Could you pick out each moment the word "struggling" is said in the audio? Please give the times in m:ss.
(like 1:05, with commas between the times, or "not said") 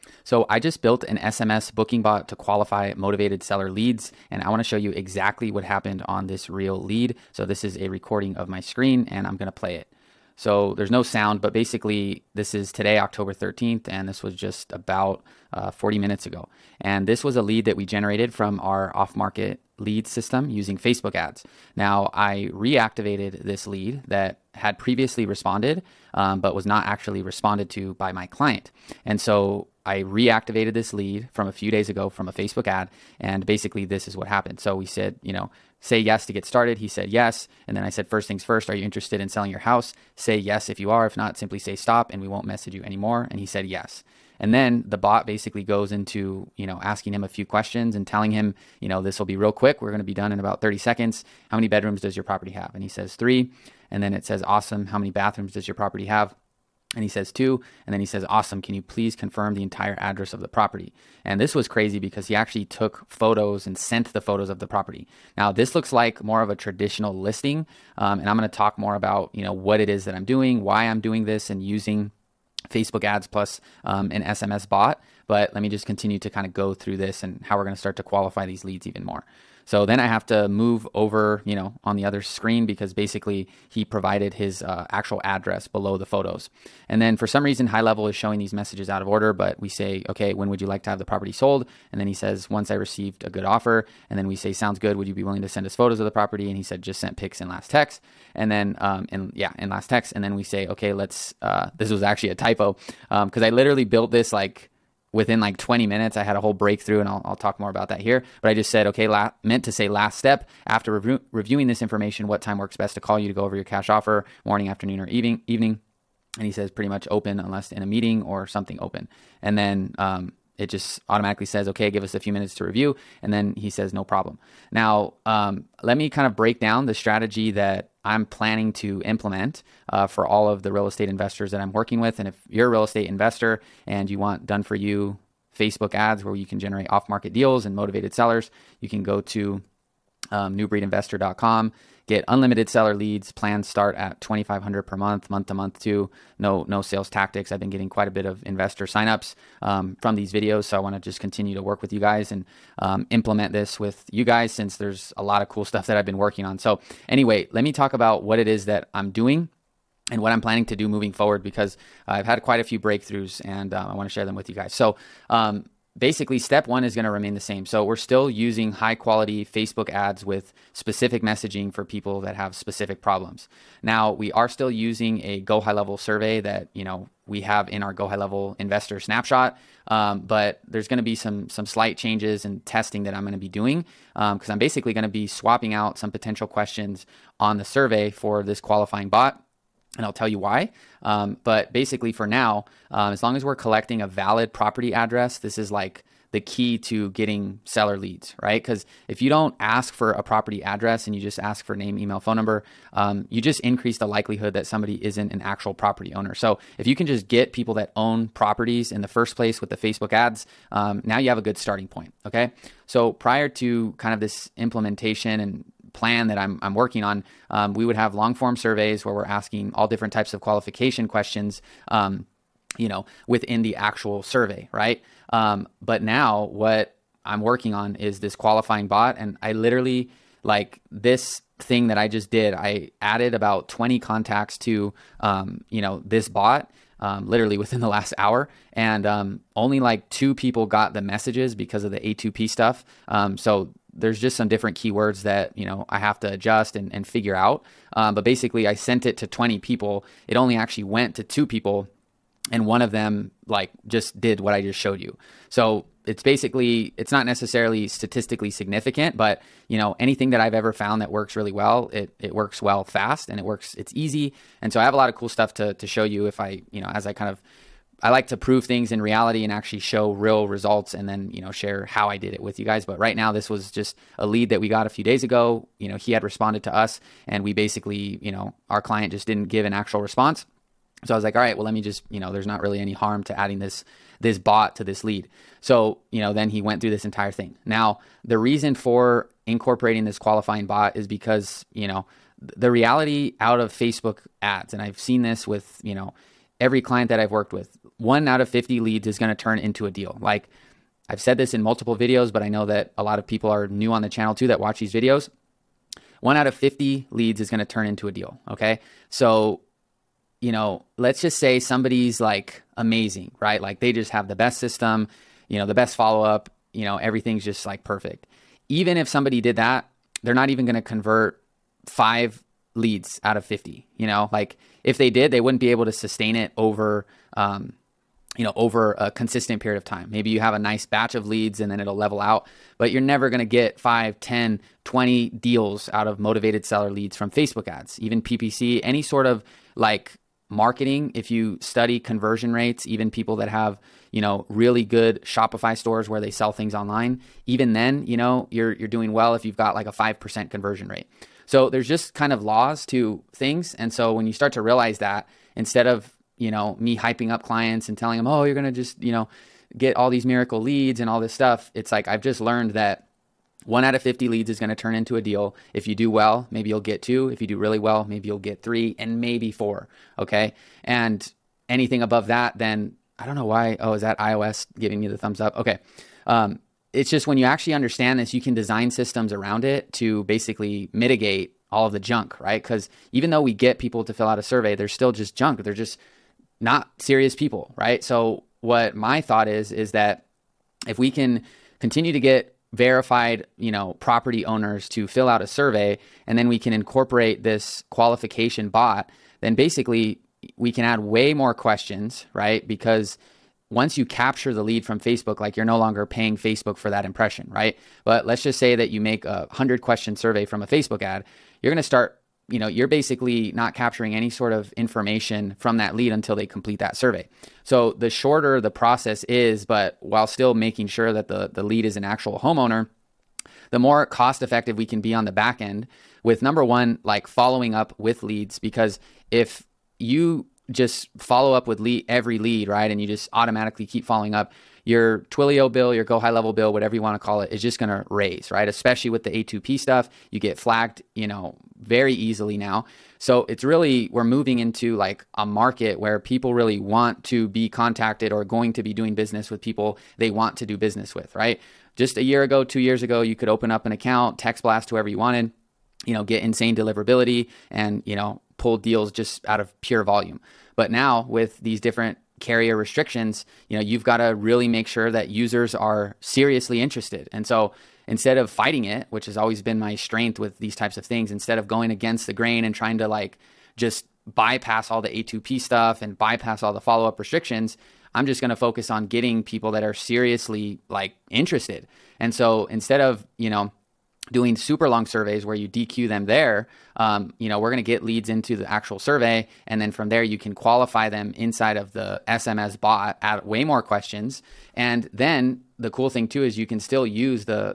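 not said.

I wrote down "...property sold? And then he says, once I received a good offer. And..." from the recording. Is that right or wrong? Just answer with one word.
right.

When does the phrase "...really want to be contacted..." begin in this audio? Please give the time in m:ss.
7:26.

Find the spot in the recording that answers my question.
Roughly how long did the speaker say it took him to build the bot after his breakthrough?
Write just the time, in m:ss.
1:45.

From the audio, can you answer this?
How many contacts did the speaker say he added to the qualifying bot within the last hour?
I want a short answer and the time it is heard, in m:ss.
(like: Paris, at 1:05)
20, at 3:53.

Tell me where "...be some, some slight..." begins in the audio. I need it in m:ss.
3:01.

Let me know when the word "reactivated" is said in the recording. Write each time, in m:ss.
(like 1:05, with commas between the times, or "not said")
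0:22, 0:30.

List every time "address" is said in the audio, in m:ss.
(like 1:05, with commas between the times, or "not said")
1:00, 1:25, 3:14, 3:20.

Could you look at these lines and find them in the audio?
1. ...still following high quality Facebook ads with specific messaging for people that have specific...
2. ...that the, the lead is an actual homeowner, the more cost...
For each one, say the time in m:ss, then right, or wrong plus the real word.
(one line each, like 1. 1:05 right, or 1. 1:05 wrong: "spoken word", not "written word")
1. 2:47 wrong: "using", not "following"
2. 7:01 right.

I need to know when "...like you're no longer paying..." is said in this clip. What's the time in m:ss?
6:45.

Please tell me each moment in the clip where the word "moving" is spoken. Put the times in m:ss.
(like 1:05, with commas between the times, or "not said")
2:40, 7:24.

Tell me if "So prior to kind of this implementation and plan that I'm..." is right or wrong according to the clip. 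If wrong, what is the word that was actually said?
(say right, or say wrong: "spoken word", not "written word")
right.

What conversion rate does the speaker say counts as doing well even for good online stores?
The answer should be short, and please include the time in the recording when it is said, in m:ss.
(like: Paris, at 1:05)
5%, at 5:49.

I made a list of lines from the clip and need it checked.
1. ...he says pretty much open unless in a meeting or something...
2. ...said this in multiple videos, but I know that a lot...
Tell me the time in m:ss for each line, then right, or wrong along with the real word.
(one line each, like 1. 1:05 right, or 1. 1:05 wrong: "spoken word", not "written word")
1. 1:56 right
2. 5:01 right.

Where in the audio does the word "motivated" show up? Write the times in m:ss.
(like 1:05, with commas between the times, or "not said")
0:02, 2:17, 5:36.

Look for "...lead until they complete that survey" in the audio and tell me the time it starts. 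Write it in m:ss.
6:55.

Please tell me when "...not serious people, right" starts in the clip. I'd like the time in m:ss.
6:26.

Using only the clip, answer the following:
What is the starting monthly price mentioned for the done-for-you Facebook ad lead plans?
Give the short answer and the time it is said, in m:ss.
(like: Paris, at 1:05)
2500, at 2:24.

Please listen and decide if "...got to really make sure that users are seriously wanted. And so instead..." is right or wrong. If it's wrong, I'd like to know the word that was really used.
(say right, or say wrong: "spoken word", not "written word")
wrong: "interested", not "wanted".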